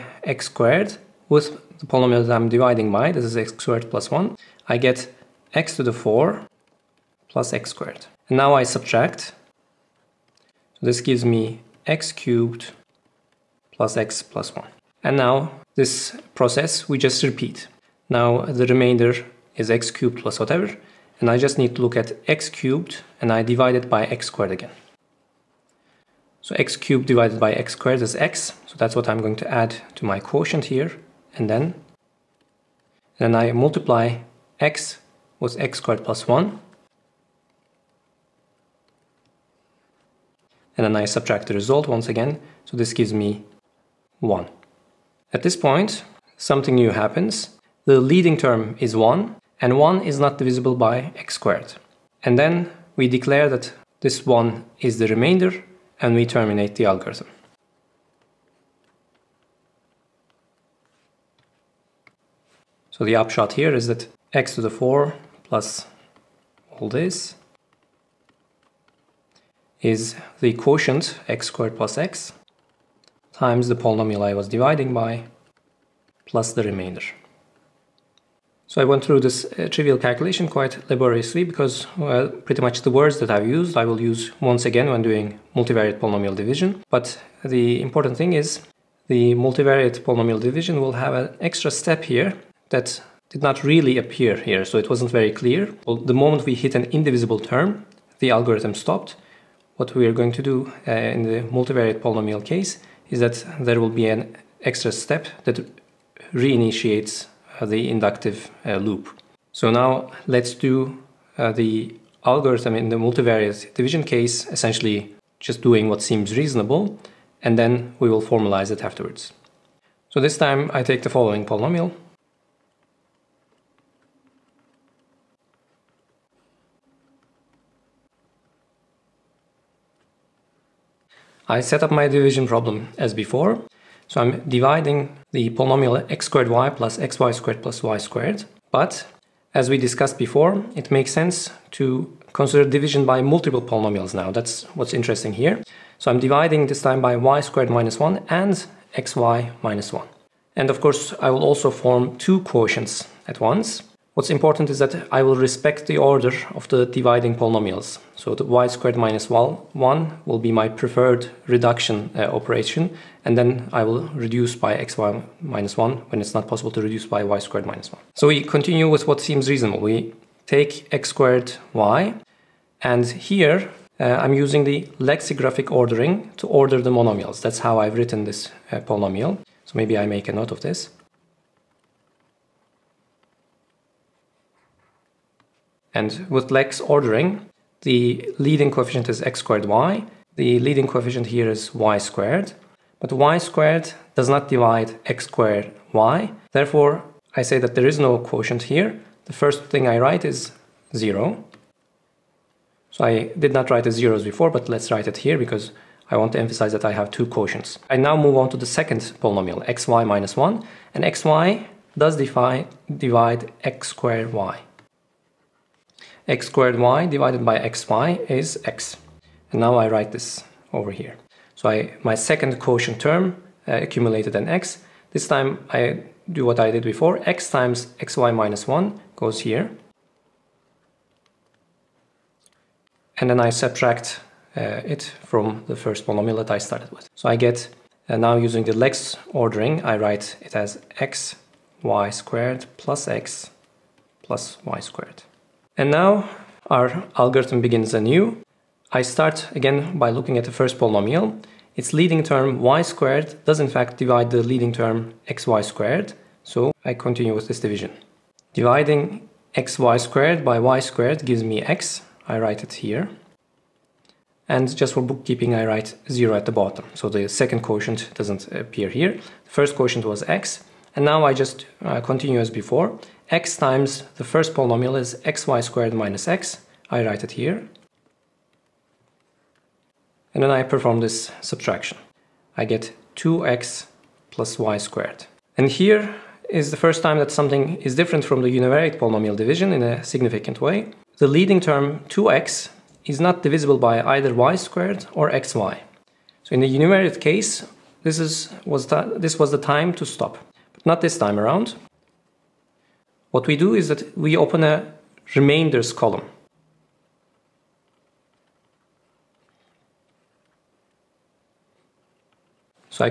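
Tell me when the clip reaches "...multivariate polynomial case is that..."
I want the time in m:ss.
1:41.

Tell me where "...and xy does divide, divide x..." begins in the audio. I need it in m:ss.
3:30.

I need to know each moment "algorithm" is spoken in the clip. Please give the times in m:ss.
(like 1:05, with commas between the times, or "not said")
0:56, 1:38, 1:52, 4:07.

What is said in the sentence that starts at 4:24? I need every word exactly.
And just for bookkeeping, I write 0 at the bottom, so the second quotient doesn't appear here.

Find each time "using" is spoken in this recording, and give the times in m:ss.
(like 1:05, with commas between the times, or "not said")
2:54, 3:58.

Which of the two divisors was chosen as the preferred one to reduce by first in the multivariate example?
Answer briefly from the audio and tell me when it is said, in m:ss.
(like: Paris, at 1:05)
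y squared minus 1, at 2:38.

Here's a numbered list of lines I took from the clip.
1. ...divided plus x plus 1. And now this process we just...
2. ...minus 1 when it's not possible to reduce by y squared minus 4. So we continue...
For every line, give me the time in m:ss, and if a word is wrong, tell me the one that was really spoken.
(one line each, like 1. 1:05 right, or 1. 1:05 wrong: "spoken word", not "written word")
1. 0:12 wrong: "cubed", not "divided"
2. 2:45 wrong: "1", not "4".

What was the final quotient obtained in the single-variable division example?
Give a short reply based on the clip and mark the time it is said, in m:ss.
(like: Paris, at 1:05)
x squared plus x, at 1:10.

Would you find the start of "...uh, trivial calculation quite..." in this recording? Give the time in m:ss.
1:19.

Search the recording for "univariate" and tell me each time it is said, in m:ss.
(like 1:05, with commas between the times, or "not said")
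4:48, 4:56.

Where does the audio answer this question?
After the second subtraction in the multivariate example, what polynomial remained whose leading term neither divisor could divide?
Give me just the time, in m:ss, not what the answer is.
4:43.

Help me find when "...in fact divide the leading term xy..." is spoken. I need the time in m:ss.
4:13.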